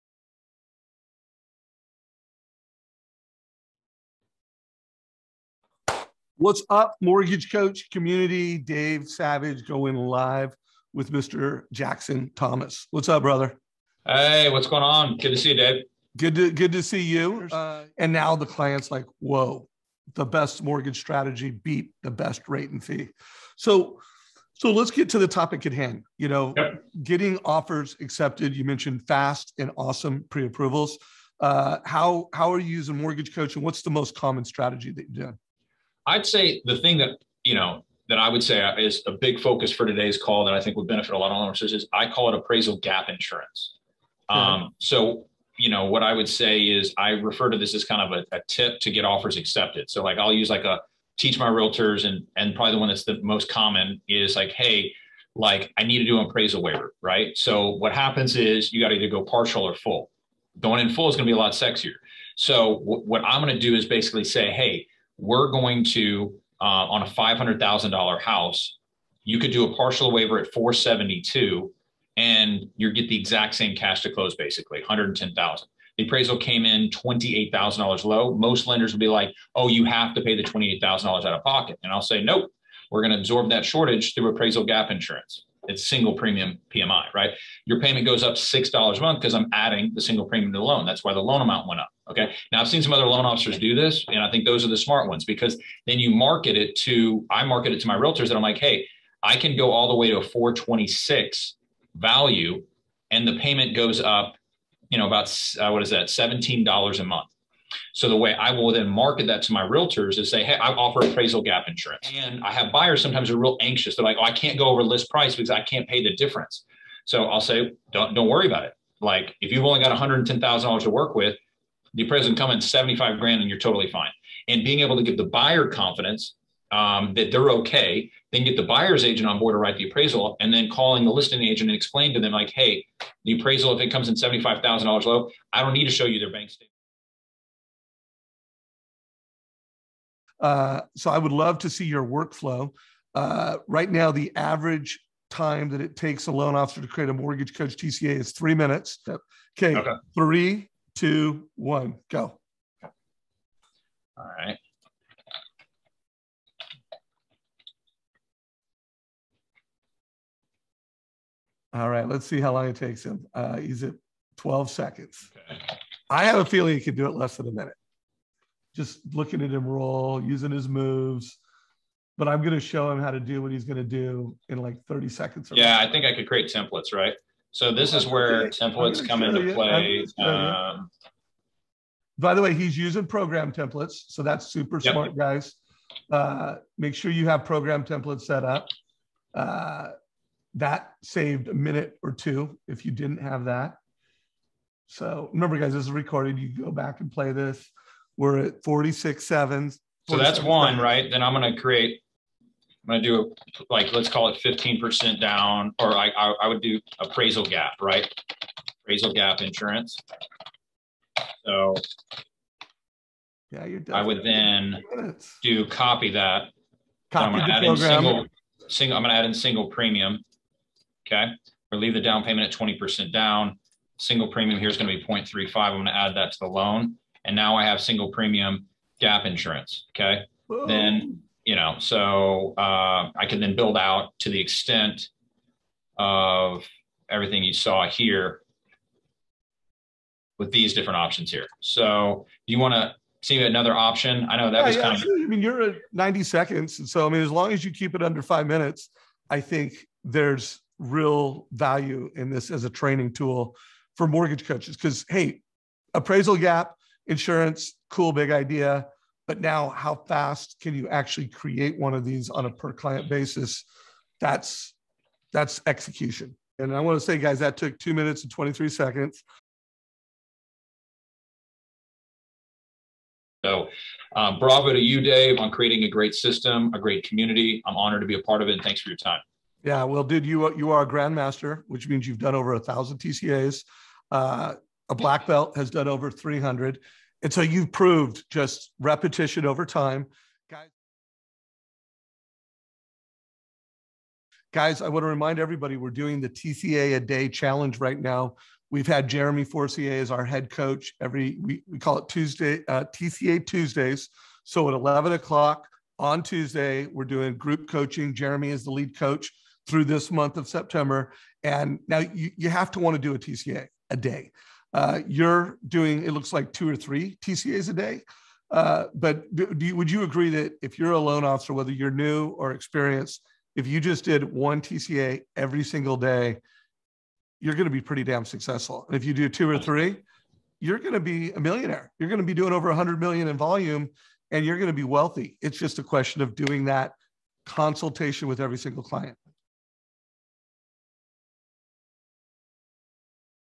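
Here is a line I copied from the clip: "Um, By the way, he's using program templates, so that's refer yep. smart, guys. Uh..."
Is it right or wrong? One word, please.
wrong.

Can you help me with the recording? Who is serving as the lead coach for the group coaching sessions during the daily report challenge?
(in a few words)
Jeremy Forcier.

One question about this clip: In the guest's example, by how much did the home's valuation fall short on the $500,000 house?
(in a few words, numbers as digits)
$28,000.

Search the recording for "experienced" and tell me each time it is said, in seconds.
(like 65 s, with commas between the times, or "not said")
322 s.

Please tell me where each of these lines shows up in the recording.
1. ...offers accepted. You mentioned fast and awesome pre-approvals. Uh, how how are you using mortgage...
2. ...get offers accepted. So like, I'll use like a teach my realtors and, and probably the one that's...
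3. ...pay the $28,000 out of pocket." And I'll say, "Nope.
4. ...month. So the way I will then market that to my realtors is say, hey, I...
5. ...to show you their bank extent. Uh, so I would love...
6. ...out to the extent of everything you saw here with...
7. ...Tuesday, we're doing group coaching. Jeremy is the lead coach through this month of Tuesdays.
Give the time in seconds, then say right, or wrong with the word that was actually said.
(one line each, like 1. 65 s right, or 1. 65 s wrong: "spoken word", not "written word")
1. 27 s right
2. 48 s right
3. 80 s right
4. 107 s right
5. 135 s wrong: "statement", not "extent"
6. 233 s right
7. 306 s wrong: "September", not "Tuesdays".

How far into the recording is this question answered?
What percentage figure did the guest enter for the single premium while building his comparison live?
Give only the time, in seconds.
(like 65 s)
225 s.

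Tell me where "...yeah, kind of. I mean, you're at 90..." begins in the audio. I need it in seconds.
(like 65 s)
244 s.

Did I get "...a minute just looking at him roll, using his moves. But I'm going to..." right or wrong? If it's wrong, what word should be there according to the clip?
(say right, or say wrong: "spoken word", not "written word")
right.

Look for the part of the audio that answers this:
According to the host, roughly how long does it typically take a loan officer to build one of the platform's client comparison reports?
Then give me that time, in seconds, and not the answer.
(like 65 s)
148 s.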